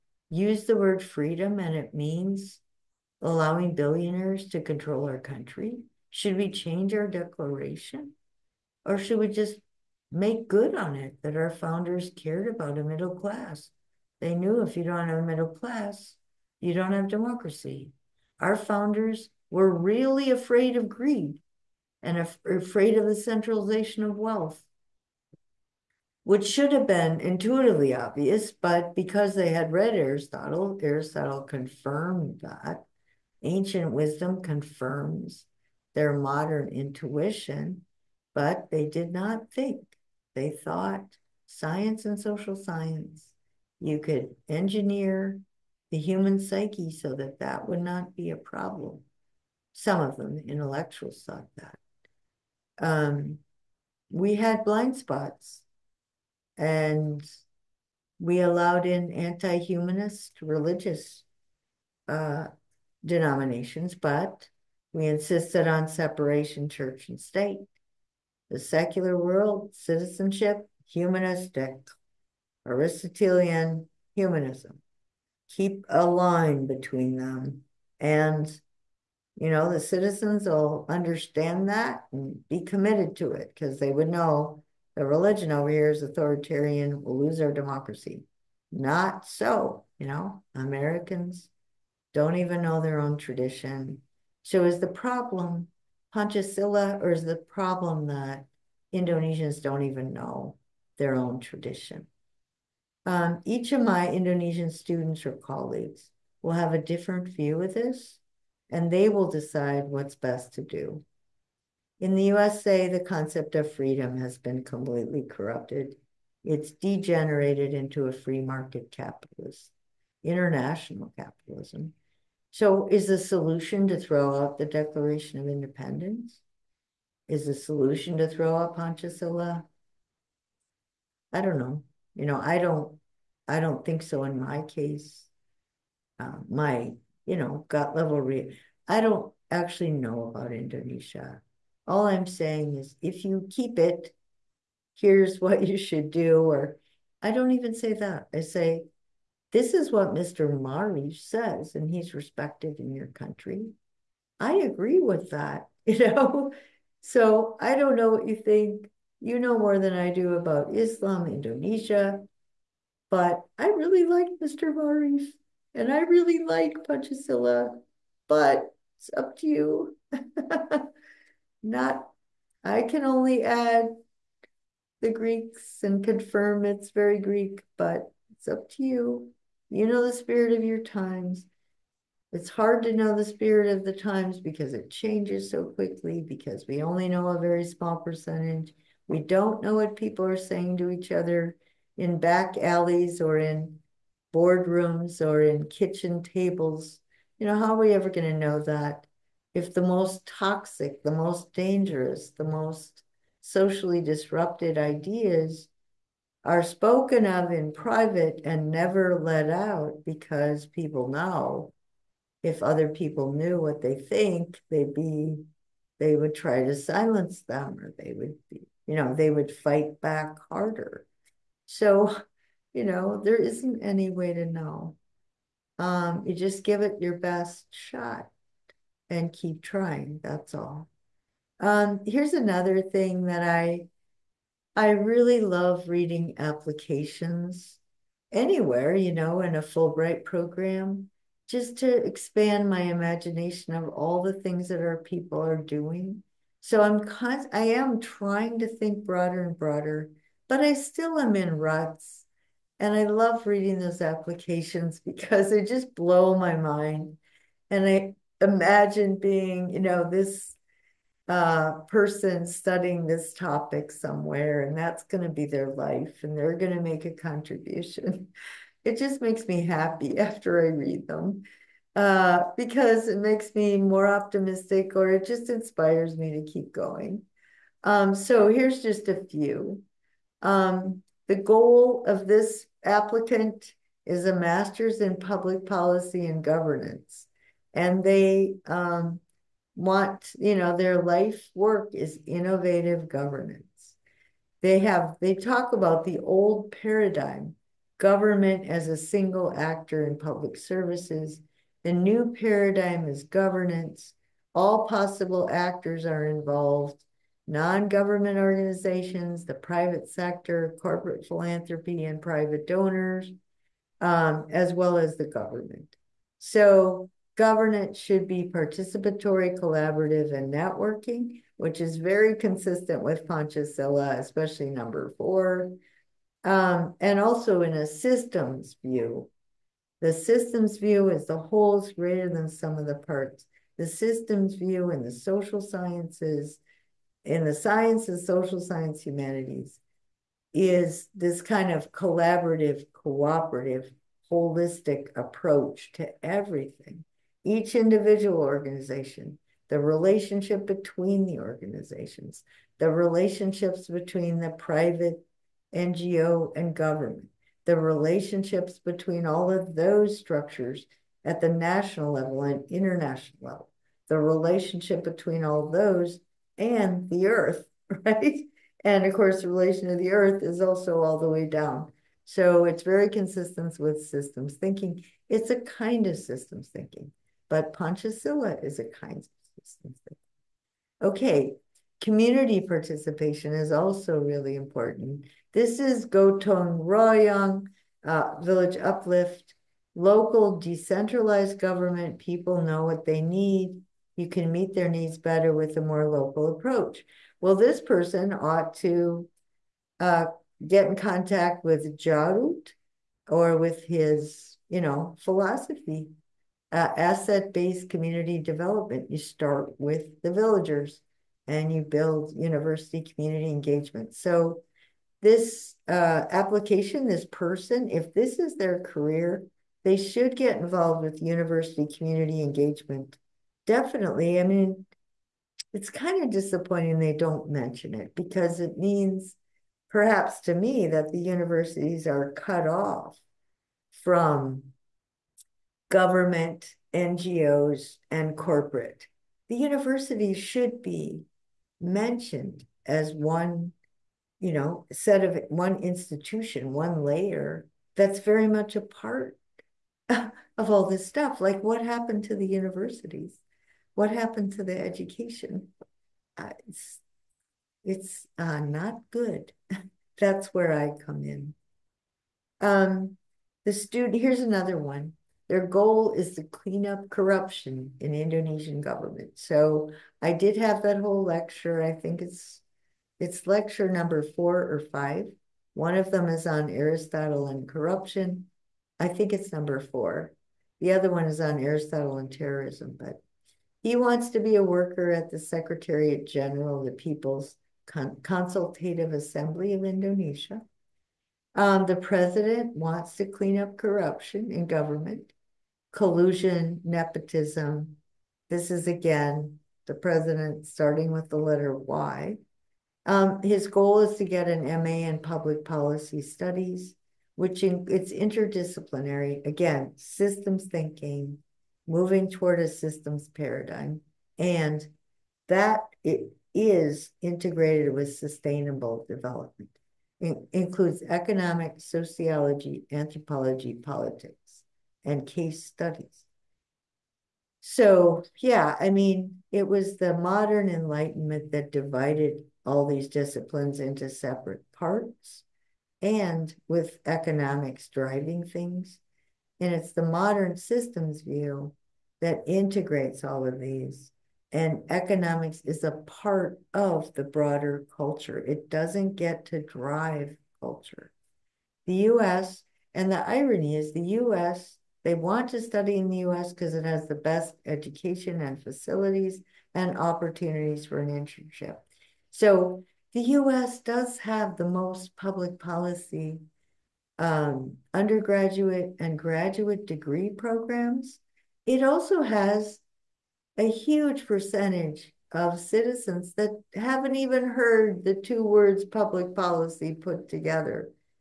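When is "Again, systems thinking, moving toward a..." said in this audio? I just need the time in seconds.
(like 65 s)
509 s.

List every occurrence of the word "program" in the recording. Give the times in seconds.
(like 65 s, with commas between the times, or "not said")
240 s, 570 s.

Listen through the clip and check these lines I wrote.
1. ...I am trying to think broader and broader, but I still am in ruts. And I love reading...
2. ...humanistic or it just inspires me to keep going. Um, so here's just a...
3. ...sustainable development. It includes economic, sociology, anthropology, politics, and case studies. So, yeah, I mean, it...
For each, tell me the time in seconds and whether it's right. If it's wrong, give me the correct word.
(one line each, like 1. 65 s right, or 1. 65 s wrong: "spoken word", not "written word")
1. 247 s right
2. 274 s wrong: "optimistic", not "humanistic"
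3. 518 s right.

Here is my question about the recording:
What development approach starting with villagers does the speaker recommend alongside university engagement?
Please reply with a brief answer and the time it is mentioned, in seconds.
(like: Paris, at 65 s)
asset-based community development, at 406 s.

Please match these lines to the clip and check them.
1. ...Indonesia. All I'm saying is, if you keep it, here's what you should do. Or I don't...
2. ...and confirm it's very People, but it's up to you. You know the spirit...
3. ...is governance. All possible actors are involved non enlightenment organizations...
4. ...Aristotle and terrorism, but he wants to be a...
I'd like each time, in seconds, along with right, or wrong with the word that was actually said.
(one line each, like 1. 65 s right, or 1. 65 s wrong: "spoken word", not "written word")
1. 140 s right
2. 175 s wrong: "Greek", not "People"
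3. 303 s wrong: "government", not "enlightenment"
4. 481 s right.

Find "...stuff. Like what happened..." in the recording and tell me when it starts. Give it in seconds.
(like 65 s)
451 s.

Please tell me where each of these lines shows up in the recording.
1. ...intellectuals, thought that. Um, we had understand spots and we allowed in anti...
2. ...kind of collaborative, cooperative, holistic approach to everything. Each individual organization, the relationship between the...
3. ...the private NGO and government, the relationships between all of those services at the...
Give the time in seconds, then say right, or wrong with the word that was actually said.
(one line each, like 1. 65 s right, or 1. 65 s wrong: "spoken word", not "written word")
1. 50 s wrong: "blind", not "understand"
2. 341 s right
3. 354 s wrong: "structures", not "services".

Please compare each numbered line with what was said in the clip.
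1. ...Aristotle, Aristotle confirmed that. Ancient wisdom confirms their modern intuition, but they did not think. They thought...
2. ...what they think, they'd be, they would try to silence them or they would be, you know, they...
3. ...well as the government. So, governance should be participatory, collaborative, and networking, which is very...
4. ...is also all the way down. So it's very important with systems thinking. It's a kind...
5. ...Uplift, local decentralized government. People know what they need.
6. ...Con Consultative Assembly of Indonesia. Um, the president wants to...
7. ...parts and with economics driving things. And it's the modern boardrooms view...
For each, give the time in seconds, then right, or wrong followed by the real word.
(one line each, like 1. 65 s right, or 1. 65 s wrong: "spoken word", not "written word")
1. 29 s right
2. 213 s right
3. 314 s right
4. 370 s wrong: "consistent", not "important"
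5. 388 s right
6. 487 s right
7. 534 s wrong: "systems", not "boardrooms".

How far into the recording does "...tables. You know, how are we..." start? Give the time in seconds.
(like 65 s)
196 s.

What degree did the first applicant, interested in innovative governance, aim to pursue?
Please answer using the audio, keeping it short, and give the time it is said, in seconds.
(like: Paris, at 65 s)
master's in public policy and governance, at 284 s.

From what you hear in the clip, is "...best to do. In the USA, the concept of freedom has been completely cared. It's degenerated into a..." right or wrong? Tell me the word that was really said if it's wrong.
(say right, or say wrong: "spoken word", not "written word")
wrong: "corrupted", not "cared".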